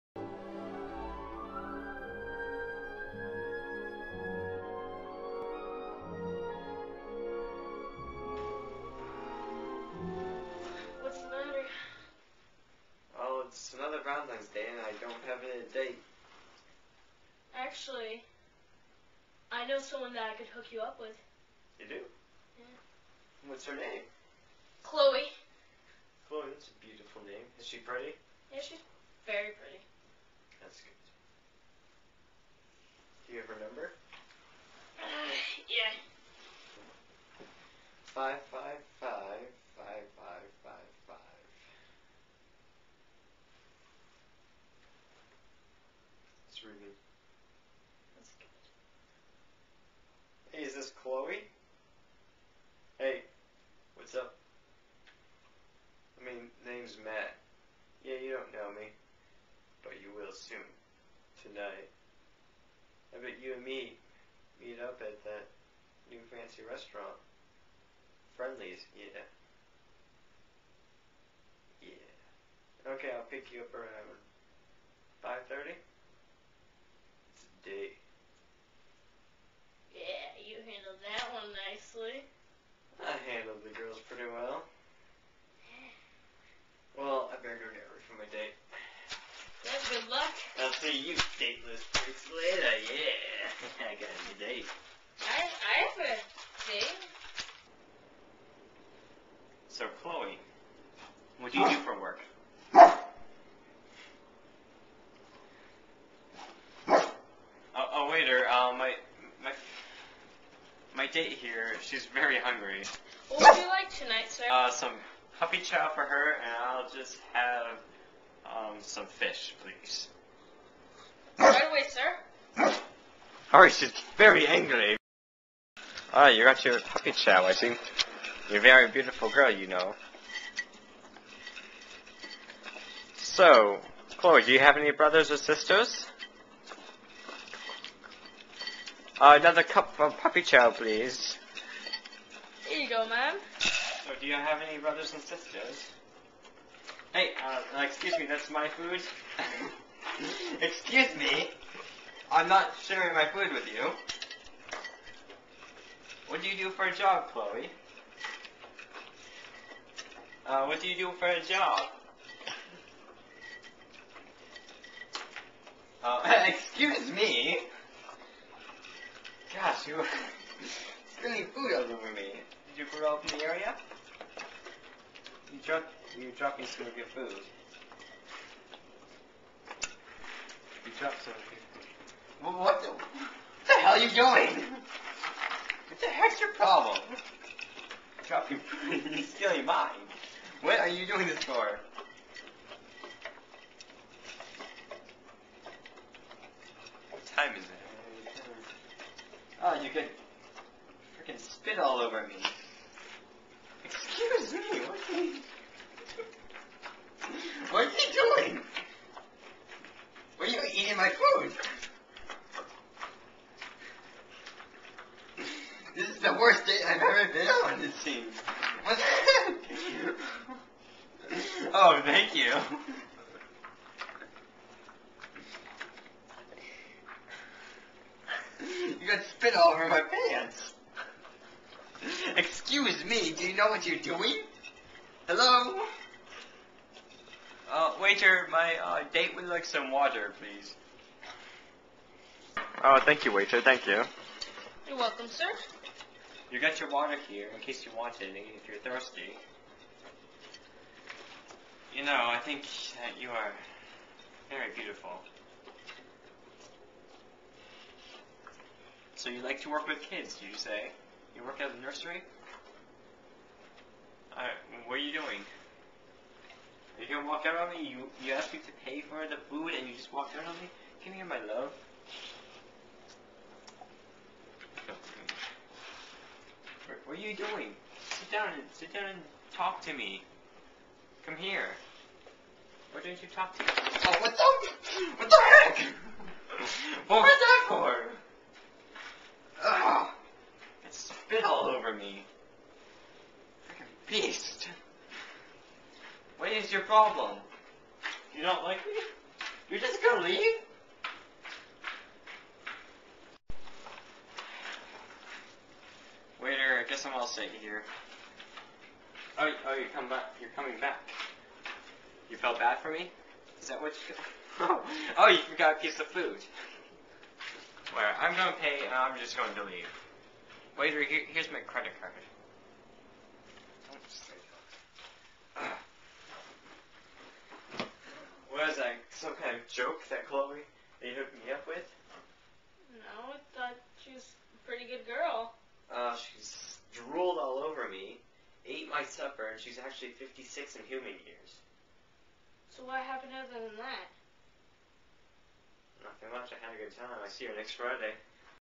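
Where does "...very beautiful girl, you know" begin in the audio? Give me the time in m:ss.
2:08.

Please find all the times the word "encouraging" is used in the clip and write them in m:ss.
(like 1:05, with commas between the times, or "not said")
not said.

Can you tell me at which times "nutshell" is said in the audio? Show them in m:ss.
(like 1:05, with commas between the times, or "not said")
not said.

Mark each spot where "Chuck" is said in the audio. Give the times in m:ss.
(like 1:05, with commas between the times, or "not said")
2:55, 3:00, 3:08.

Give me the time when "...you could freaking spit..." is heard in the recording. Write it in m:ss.
3:19.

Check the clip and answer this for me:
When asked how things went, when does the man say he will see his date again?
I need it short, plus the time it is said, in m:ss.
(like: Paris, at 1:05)
Next Friday, at 5:47.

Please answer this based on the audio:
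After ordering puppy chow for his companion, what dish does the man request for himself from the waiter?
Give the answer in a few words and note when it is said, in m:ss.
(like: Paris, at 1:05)
Fish, at 1:59.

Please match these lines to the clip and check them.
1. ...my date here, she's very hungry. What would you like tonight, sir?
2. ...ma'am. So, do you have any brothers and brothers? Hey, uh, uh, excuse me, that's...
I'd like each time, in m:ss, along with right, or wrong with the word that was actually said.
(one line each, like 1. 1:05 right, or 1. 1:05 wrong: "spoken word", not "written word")
1. 1:50 right
2. 2:23 wrong: "sisters", not "brothers".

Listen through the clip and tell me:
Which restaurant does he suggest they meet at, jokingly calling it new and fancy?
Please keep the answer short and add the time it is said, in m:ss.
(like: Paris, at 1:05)
Friendly's, at 1:08.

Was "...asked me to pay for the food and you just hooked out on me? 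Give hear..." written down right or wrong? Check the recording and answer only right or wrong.
wrong.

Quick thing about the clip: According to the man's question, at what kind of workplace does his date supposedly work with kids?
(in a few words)
Nursery.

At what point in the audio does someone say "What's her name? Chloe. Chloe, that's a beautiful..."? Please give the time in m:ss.
0:23.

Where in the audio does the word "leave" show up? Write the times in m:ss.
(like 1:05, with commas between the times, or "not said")
5:00, 5:19.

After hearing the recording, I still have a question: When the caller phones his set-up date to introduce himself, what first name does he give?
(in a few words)
Matt.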